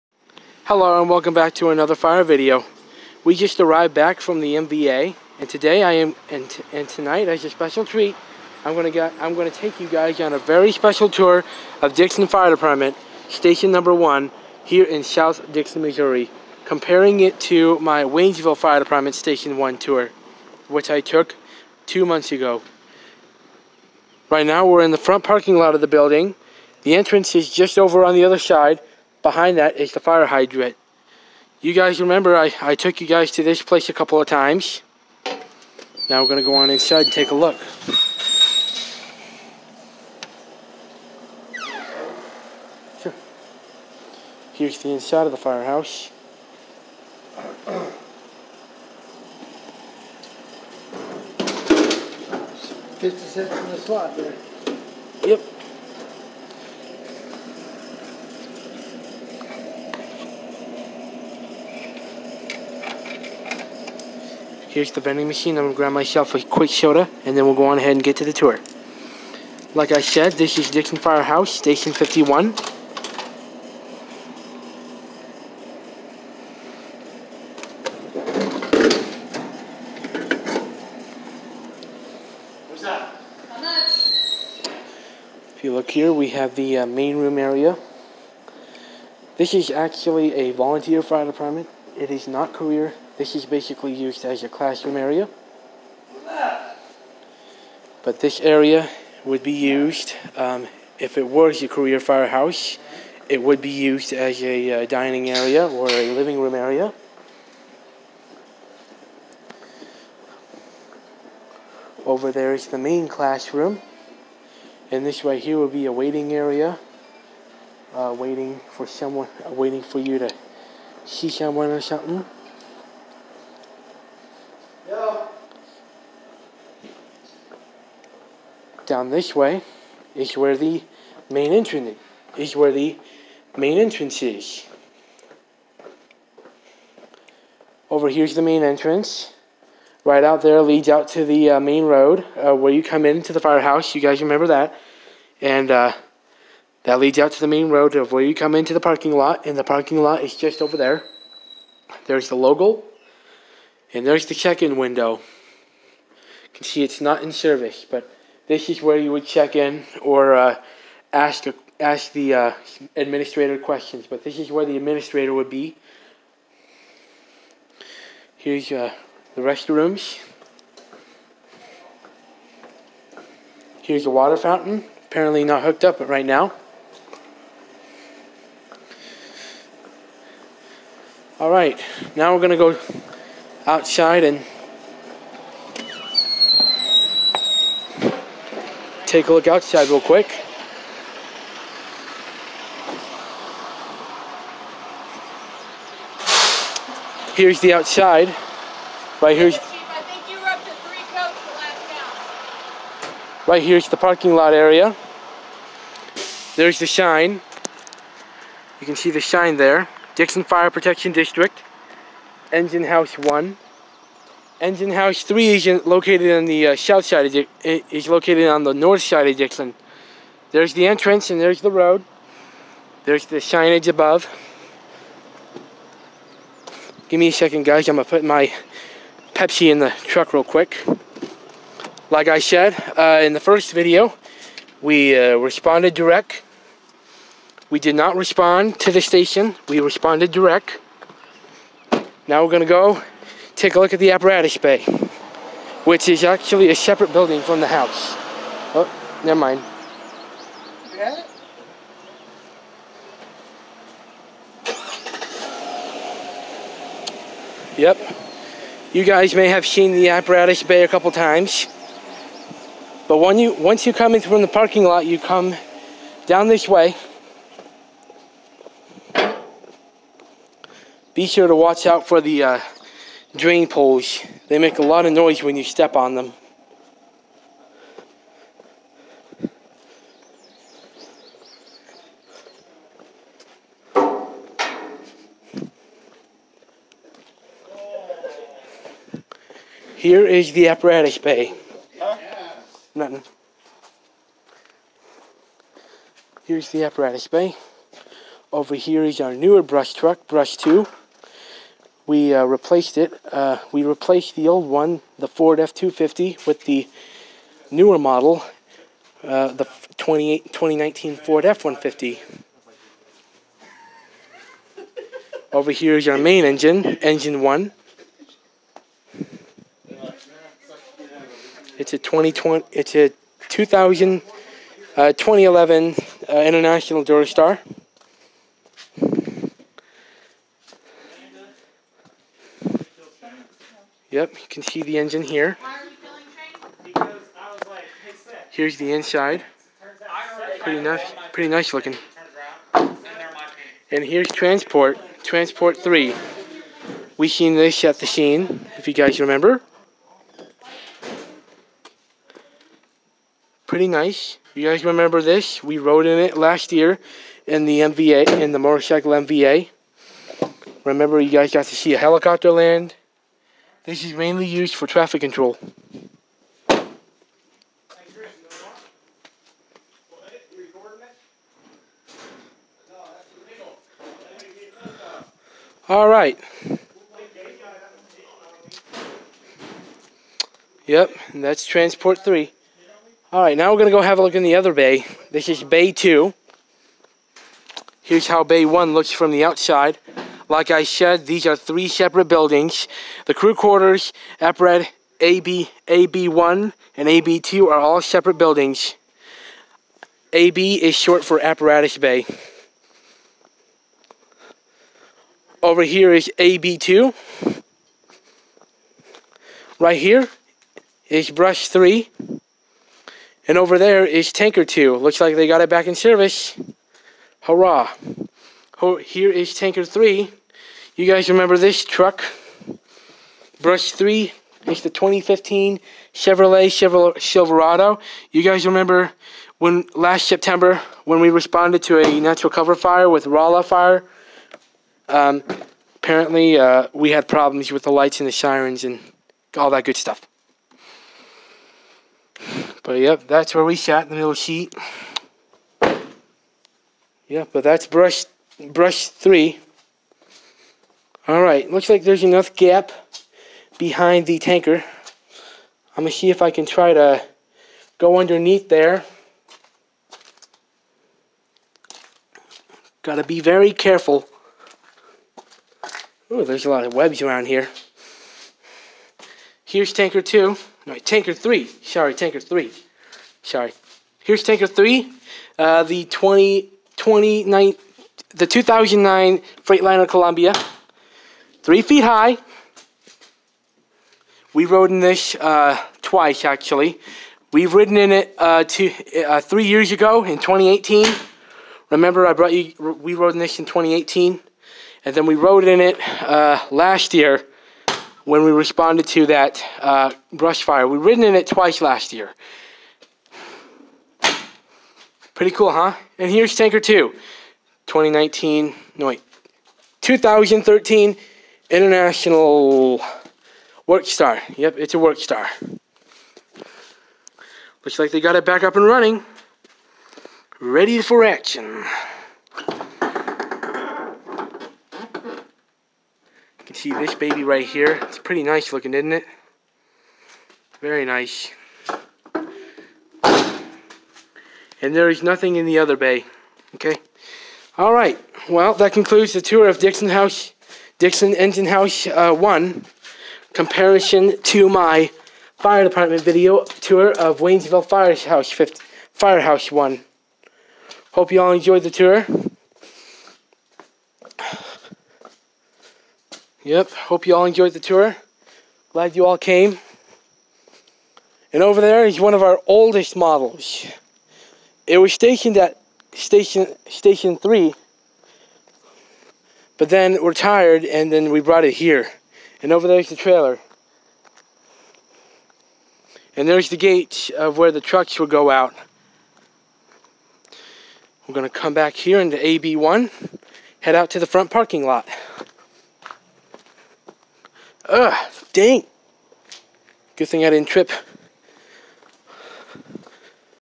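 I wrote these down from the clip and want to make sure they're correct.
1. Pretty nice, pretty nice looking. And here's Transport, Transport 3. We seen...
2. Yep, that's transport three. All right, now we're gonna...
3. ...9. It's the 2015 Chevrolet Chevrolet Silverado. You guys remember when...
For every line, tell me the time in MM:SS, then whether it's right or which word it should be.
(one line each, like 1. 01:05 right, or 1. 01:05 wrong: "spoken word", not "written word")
1. 05:40 right
2. 06:20 right
3. 07:03 wrong: "3", not "9".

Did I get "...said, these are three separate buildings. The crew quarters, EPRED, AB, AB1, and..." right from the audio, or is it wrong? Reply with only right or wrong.
right.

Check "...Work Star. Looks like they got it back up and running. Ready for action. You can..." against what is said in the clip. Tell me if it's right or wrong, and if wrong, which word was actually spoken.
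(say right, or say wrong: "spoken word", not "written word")
right.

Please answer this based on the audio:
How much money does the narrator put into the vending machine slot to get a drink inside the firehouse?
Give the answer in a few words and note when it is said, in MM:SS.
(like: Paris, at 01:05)
50 cents, at 00:52.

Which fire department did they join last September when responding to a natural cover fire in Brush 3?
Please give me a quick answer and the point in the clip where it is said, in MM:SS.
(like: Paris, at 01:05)
Rolla fire, at 07:13.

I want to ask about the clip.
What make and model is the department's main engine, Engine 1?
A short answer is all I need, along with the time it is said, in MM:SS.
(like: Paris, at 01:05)
International Durastar, at 05:26.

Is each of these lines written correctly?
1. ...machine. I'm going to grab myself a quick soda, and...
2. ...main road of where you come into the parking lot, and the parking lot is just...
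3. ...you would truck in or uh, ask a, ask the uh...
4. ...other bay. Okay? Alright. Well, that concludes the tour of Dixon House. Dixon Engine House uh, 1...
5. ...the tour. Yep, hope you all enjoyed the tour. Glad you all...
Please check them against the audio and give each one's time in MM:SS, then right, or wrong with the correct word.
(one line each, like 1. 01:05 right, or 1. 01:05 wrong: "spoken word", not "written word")
1. 01:05 right
2. 02:27 right
3. 02:38 wrong: "check", not "truck"
4. 08:55 right
5. 09:11 right.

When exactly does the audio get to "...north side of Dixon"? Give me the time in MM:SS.
03:38.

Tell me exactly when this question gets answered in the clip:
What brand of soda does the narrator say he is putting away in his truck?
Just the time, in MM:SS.
03:49.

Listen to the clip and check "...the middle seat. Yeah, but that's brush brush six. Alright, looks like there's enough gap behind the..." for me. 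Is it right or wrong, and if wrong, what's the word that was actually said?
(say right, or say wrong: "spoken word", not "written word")
wrong: "three", not "six".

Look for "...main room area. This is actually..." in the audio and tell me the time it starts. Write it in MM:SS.
01:26.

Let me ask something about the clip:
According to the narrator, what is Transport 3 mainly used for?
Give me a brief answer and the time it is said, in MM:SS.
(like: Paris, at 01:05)
Traffic control, at 06:04.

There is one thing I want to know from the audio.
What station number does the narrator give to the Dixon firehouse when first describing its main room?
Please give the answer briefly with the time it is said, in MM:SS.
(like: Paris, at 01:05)
51, at 01:11.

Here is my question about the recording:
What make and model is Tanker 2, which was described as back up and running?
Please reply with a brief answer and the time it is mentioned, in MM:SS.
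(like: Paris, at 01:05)
International Work Star, at 08:31.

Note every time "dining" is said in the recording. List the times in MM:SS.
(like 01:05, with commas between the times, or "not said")
01:44.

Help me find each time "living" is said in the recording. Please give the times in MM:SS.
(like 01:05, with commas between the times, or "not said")
01:46.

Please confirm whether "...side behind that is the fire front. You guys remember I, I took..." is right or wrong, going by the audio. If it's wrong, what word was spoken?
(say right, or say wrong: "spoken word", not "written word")
wrong: "hydrant", not "front".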